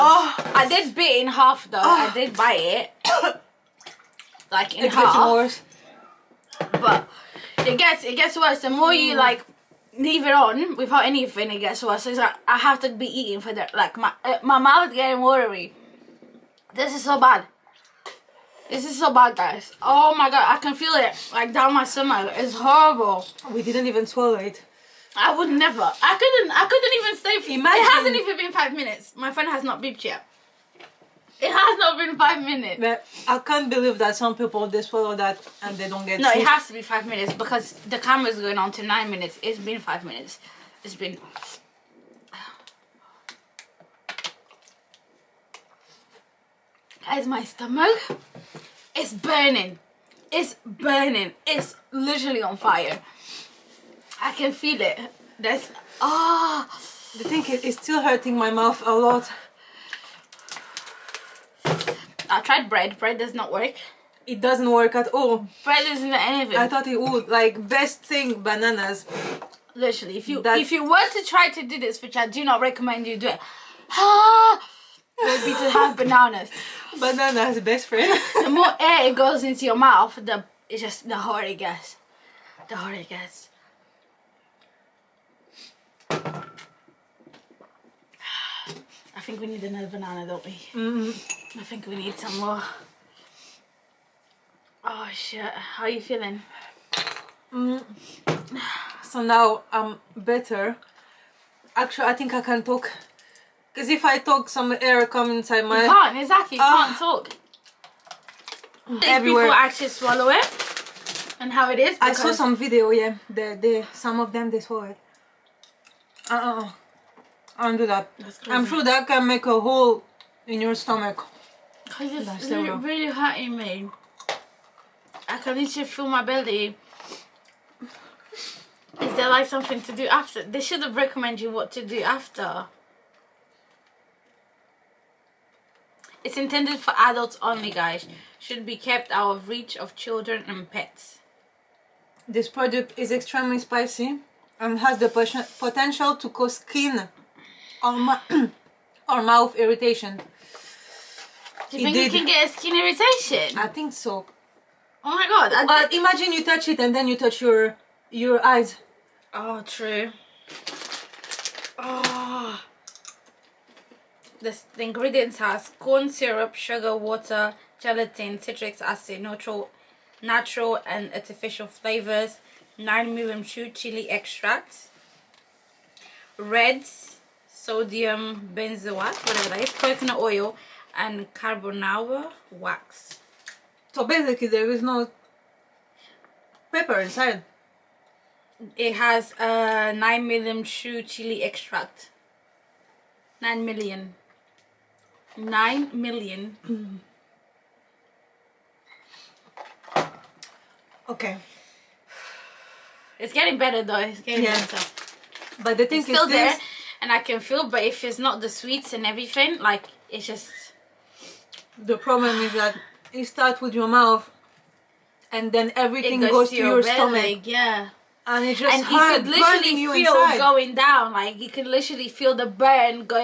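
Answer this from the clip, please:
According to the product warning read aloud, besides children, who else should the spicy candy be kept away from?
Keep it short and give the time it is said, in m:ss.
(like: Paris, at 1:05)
Pets, at 2:20.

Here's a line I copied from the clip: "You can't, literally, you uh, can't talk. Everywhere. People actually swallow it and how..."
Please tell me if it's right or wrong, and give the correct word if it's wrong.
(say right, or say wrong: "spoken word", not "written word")
wrong: "exactly", not "literally".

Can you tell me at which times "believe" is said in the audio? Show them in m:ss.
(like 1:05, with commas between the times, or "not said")
0:33.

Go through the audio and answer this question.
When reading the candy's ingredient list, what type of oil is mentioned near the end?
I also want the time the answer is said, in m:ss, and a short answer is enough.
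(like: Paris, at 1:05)
Coconut oil, at 2:59.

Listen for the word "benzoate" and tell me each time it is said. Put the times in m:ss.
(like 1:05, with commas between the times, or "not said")
2:58.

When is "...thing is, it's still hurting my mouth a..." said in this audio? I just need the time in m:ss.
0:57.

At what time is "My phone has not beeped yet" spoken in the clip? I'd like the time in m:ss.
0:29.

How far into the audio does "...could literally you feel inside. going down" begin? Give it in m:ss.
3:39.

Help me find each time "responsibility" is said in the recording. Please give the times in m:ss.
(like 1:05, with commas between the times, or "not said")
not said.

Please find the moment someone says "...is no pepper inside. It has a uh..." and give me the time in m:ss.
3:04.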